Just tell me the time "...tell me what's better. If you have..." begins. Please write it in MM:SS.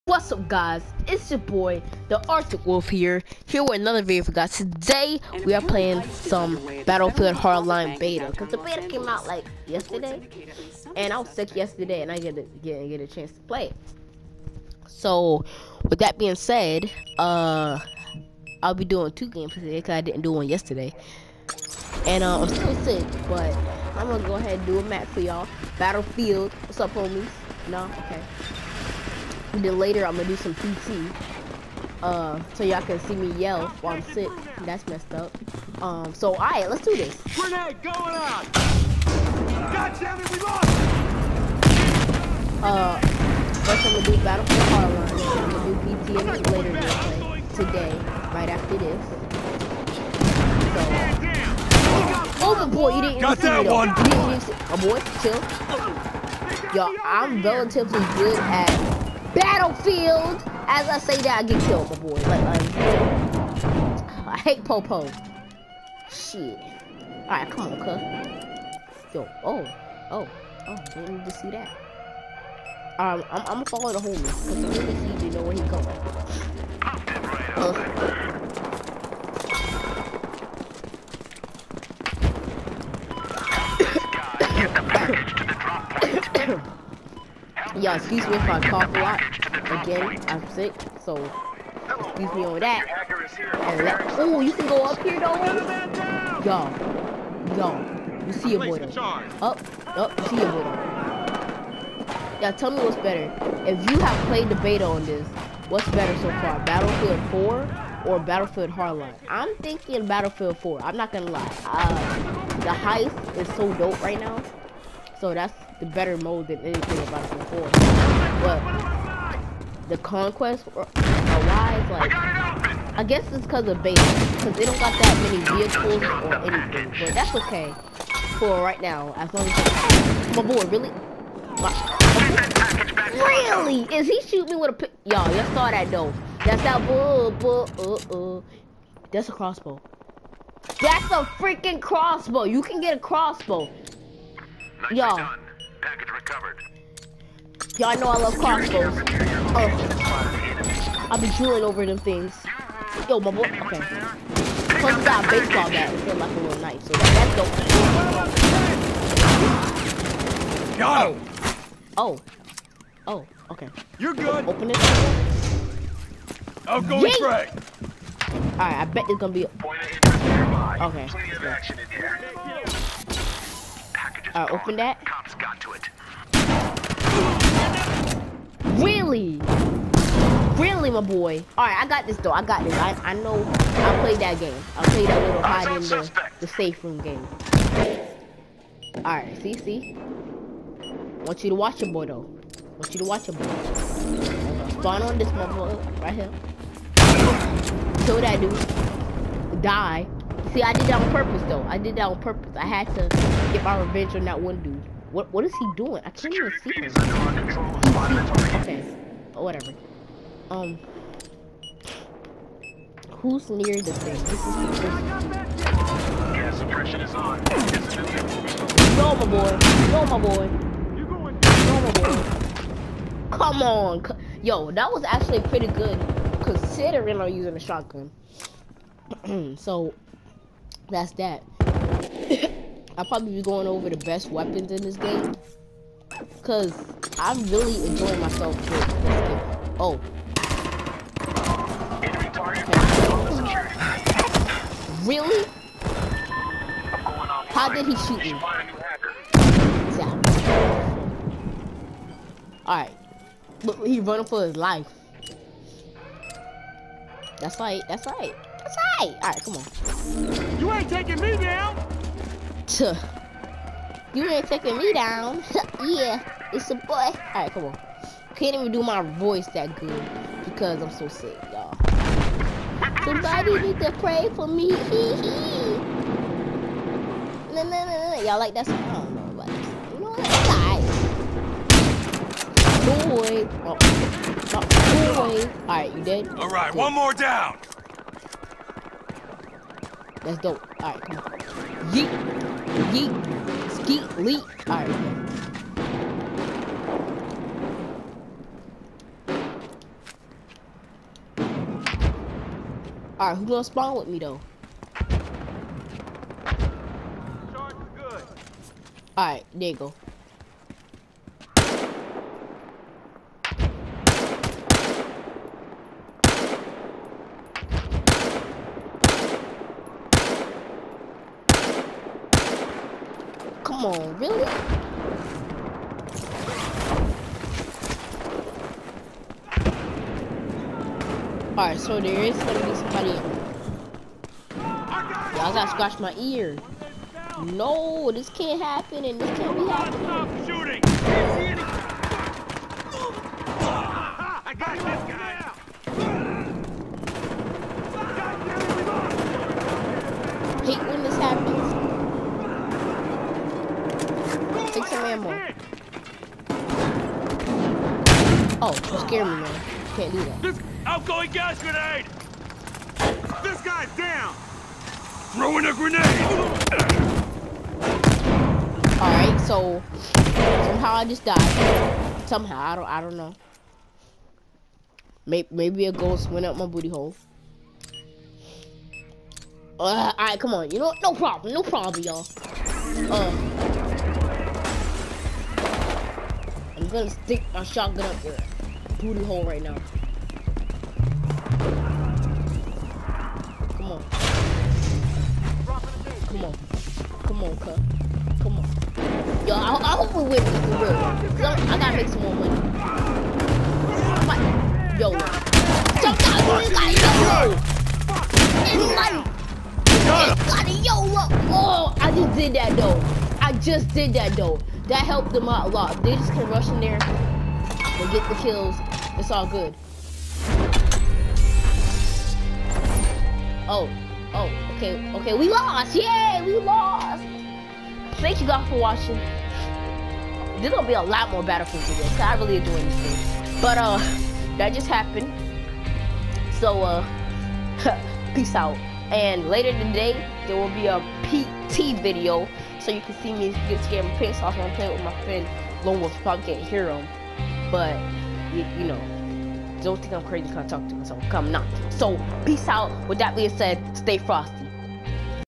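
01:42.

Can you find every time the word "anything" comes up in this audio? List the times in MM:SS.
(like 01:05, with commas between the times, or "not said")
01:56, 02:06.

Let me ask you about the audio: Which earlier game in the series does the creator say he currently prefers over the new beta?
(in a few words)
Battlefield 4.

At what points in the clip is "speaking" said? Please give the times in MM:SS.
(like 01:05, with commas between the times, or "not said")
not said.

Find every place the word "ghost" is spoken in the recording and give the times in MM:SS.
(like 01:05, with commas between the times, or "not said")
06:15.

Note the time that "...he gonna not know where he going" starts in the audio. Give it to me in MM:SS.
01:15.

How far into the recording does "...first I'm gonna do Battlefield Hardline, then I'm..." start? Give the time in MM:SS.
00:43.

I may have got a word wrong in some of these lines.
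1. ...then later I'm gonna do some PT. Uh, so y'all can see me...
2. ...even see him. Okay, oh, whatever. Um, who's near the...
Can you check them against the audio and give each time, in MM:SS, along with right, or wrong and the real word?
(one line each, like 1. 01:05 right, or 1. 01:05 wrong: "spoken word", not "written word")
1. 00:29 right
2. 03:26 right.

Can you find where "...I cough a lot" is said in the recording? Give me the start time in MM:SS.
01:28.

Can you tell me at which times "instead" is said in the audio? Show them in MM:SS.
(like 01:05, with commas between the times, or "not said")
02:35.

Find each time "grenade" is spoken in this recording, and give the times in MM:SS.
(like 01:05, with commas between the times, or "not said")
00:37, 06:01, 06:05.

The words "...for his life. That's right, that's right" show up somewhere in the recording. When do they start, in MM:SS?
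04:14.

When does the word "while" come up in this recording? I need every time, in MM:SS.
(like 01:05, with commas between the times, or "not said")
00:33.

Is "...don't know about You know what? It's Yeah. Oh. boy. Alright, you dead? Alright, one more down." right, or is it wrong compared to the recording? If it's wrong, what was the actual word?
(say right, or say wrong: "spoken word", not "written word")
wrong: "Boy", not "Yeah".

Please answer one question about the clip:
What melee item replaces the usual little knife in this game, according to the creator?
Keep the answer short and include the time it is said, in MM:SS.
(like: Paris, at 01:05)
baseball bat, at 02:35.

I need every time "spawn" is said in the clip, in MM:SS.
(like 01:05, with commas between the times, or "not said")
03:14, 05:03.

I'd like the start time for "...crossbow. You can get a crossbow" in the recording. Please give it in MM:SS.
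02:21.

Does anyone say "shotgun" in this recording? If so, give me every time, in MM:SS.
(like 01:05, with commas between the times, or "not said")
03:47, 06:27.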